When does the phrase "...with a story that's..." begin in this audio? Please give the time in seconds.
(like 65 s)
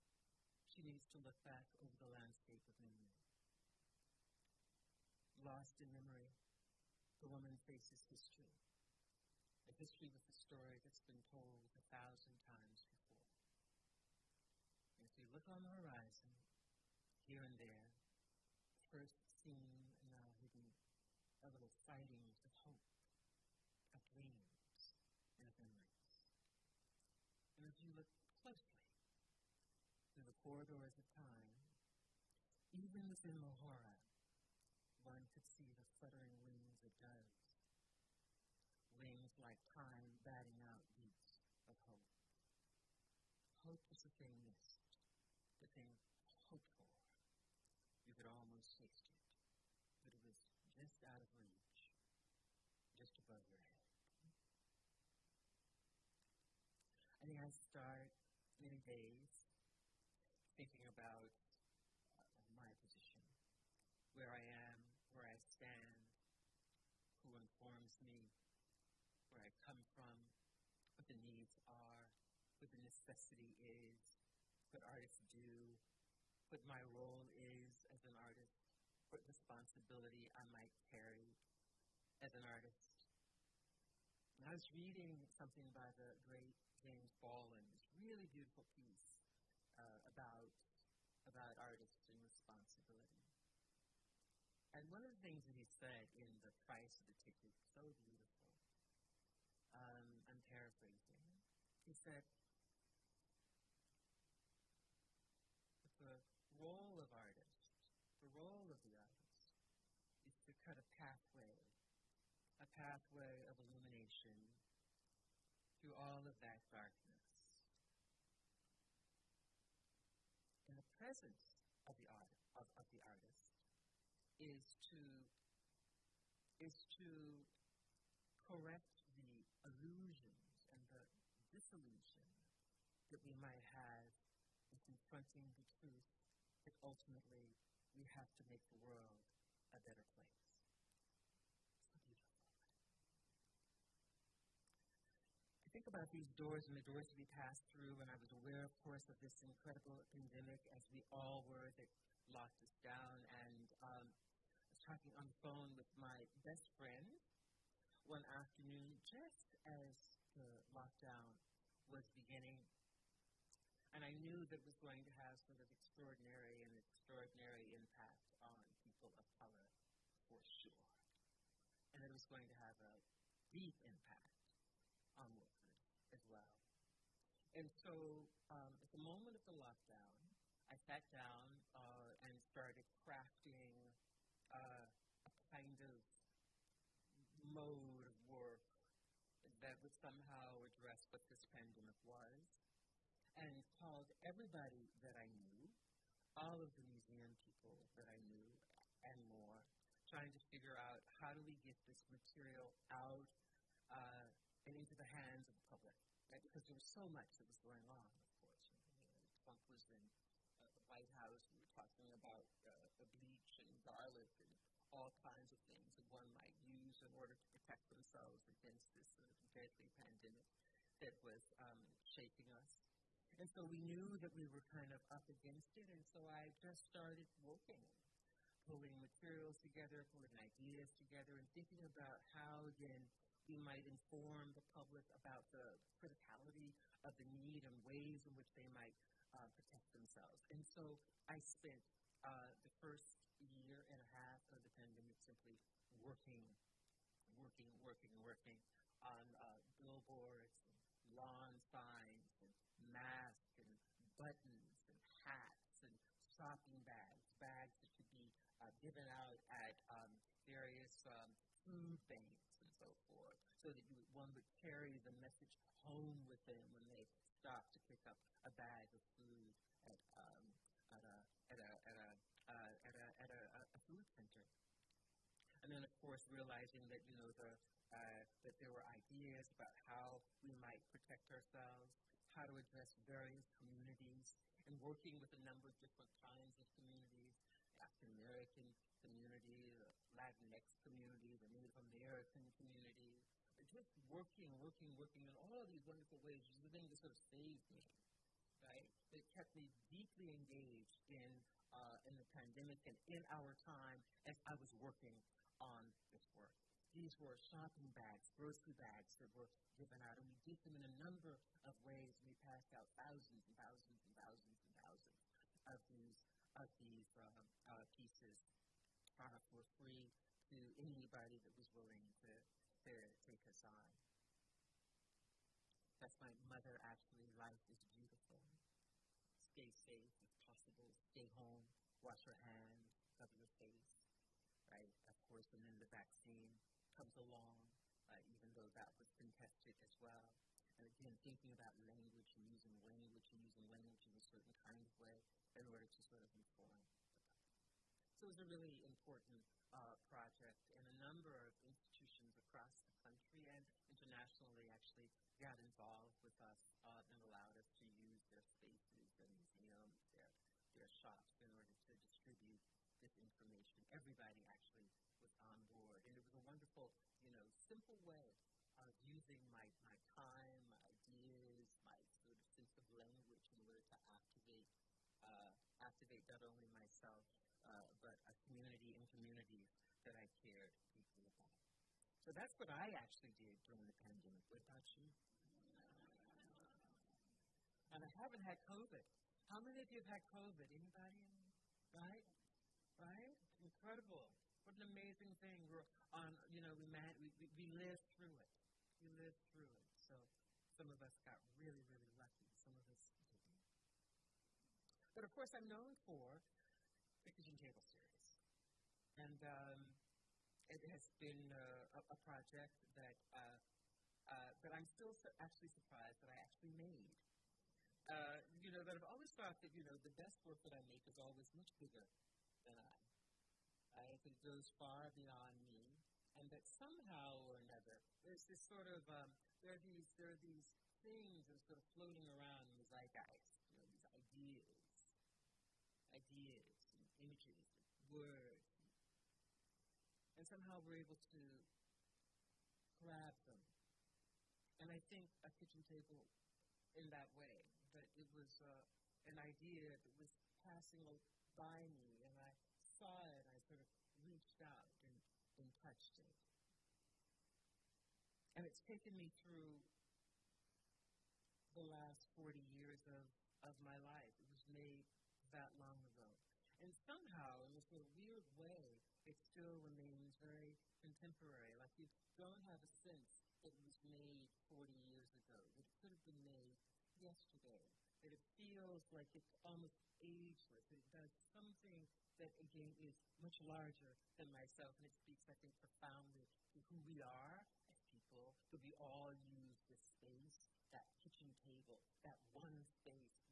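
10 s.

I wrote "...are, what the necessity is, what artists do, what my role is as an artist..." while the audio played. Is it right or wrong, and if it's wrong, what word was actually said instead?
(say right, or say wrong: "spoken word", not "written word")
right.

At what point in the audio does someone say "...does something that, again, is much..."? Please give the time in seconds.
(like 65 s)
481 s.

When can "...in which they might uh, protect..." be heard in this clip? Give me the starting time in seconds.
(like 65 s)
238 s.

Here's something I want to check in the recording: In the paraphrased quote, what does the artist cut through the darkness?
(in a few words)
A pathway of illumination.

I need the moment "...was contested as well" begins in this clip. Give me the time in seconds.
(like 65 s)
338 s.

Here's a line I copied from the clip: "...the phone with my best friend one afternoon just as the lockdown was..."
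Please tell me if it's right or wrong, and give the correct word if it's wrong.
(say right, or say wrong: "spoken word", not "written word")
right.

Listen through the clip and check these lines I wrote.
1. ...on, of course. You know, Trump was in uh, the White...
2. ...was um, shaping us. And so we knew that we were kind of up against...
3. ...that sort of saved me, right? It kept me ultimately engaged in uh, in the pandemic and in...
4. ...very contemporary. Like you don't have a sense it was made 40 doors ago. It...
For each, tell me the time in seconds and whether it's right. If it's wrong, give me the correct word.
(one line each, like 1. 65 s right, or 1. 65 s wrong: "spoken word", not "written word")
1. 207 s right
2. 221 s right
3. 296 s wrong: "deeply", not "ultimately"
4. 470 s wrong: "years", not "doors".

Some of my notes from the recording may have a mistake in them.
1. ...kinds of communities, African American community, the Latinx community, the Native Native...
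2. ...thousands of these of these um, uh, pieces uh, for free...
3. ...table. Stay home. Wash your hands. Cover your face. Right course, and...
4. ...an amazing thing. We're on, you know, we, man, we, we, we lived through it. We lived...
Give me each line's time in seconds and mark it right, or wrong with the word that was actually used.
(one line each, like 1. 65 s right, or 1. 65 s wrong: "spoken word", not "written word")
1. 286 s wrong: "American", not "Native"
2. 314 s right
3. 330 s wrong: "possible", not "table"
4. 394 s right.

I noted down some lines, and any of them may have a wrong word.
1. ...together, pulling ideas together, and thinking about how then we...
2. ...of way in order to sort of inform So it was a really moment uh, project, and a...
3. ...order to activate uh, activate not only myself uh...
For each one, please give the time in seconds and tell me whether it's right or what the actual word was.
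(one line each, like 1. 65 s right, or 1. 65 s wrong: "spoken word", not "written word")
1. 229 s right
2. 344 s wrong: "important", not "moment"
3. 373 s right.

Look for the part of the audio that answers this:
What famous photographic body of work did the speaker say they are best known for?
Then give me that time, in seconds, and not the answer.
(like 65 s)
407 s.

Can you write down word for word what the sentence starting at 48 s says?
You could almost taste it, but it was just out of reach, just above your head.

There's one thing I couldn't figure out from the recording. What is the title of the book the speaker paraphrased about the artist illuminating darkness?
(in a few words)
The Price of the Ticket.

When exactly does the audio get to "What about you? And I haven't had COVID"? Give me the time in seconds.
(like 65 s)
384 s.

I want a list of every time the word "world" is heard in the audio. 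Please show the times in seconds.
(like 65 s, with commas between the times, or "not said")
138 s.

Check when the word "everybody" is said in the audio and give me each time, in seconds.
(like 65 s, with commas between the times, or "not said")
194 s, 363 s.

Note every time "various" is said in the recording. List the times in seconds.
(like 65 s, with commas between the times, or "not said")
260 s, 283 s.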